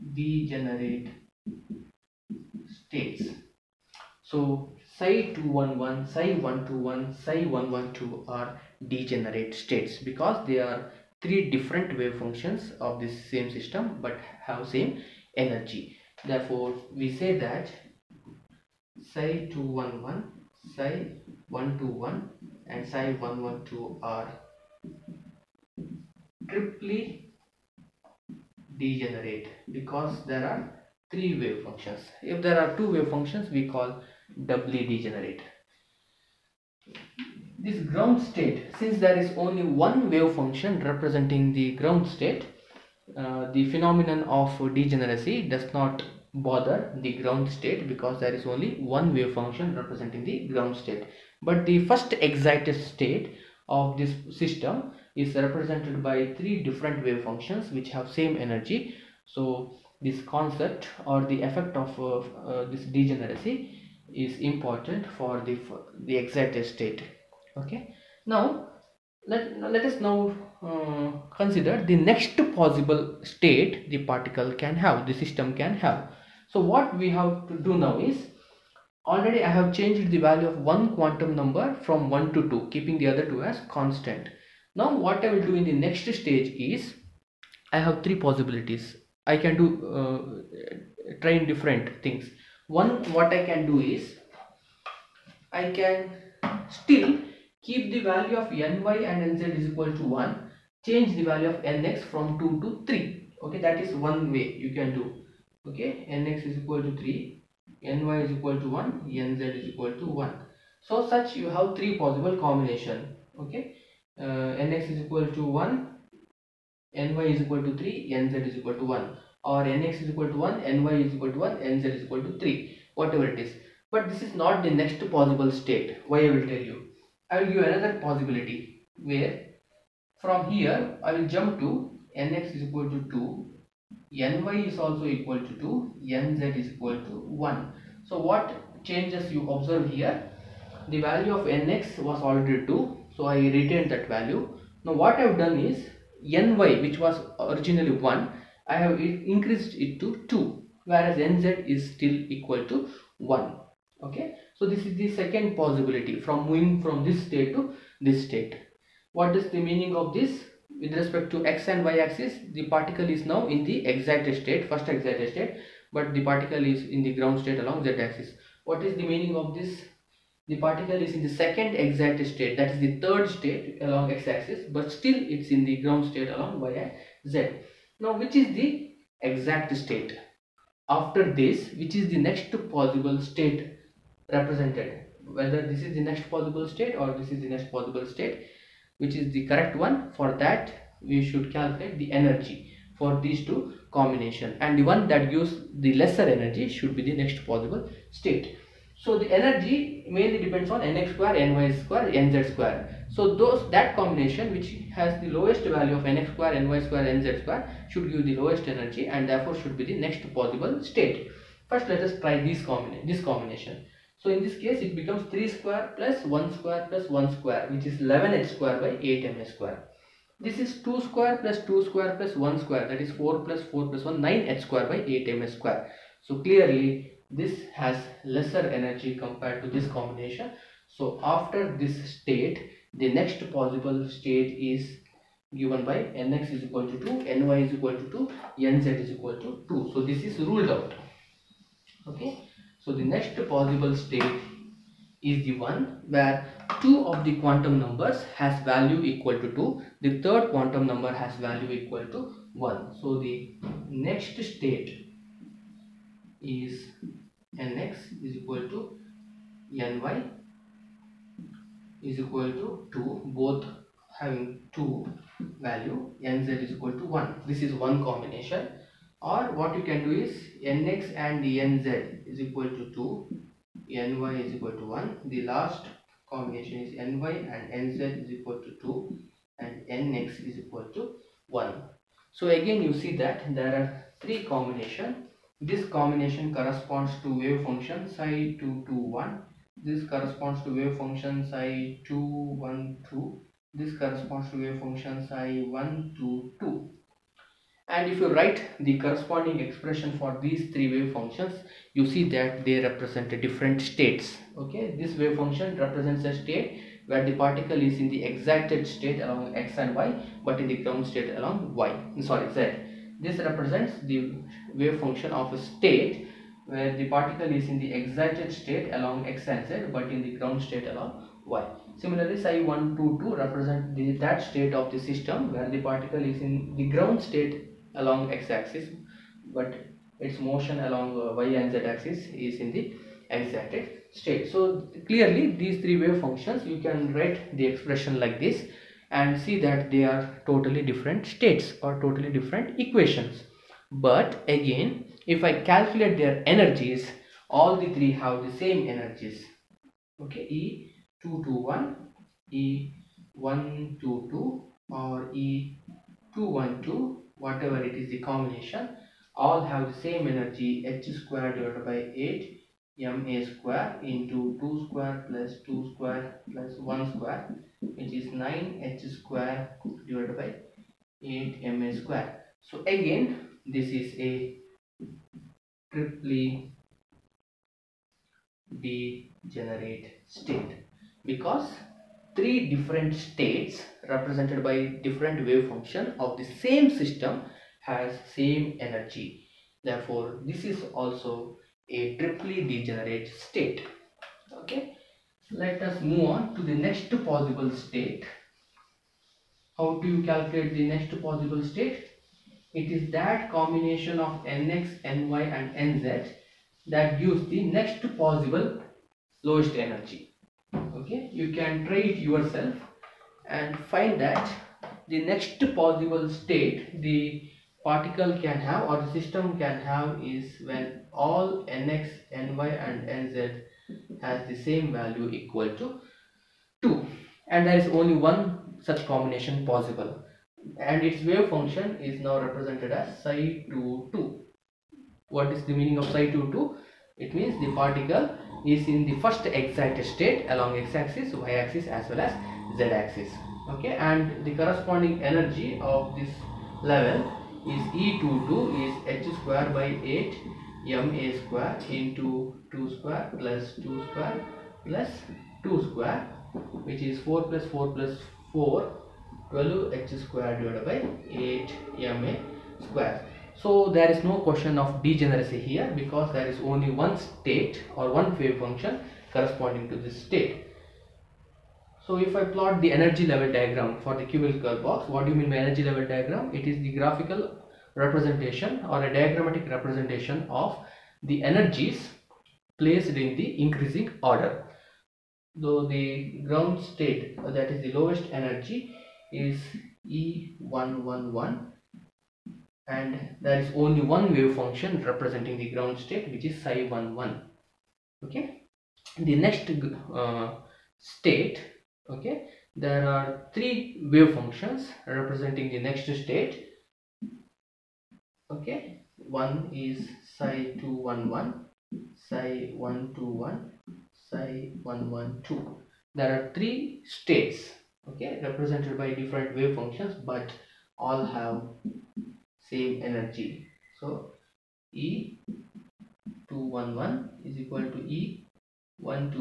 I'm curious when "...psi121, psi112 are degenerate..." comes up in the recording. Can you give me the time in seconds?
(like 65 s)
6 s.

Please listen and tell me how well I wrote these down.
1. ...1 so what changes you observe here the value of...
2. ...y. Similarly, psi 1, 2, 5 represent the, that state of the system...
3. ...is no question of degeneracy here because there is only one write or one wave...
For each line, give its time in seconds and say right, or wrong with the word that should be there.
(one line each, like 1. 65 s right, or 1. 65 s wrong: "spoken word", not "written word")
1. 137 s right
2. 321 s wrong: "2", not "5"
3. 464 s wrong: "state", not "write".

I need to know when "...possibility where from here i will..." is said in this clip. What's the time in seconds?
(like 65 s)
128 s.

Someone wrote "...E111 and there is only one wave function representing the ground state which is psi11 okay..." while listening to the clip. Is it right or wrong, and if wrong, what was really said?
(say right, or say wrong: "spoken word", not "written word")
right.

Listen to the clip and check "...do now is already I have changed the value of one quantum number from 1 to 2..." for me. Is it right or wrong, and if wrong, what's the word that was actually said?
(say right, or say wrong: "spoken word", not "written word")
right.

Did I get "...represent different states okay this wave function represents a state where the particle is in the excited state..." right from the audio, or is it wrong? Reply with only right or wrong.
right.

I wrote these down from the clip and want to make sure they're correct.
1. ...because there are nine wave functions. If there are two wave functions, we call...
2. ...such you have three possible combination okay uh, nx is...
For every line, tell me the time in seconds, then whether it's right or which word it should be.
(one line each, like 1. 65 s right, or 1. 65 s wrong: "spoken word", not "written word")
1. 29 s wrong: "three", not "nine"
2. 111 s right.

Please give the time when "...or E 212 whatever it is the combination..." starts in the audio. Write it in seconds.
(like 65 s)
354 s.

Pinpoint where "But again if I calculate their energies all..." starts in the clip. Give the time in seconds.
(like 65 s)
343 s.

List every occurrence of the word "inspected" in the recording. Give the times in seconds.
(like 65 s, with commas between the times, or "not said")
not said.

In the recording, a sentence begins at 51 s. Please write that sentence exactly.
But the first excited state of this system is represented by three different wave functions which have same energy.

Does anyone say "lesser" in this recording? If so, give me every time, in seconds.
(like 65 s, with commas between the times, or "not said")
195 s, 228 s.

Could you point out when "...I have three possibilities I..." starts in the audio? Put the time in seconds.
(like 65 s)
87 s.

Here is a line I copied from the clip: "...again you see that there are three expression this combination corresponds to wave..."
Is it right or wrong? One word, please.
wrong.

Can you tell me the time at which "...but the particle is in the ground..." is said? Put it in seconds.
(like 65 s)
165 s.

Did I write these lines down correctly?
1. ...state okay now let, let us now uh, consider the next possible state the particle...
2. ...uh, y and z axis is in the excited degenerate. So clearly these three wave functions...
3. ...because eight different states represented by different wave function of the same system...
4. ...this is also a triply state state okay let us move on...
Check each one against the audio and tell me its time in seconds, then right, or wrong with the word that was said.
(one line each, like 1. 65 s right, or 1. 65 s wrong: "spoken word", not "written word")
1. 66 s right
2. 331 s wrong: "state", not "degenerate"
3. 381 s wrong: "three", not "eight"
4. 390 s wrong: "degenerate", not "state".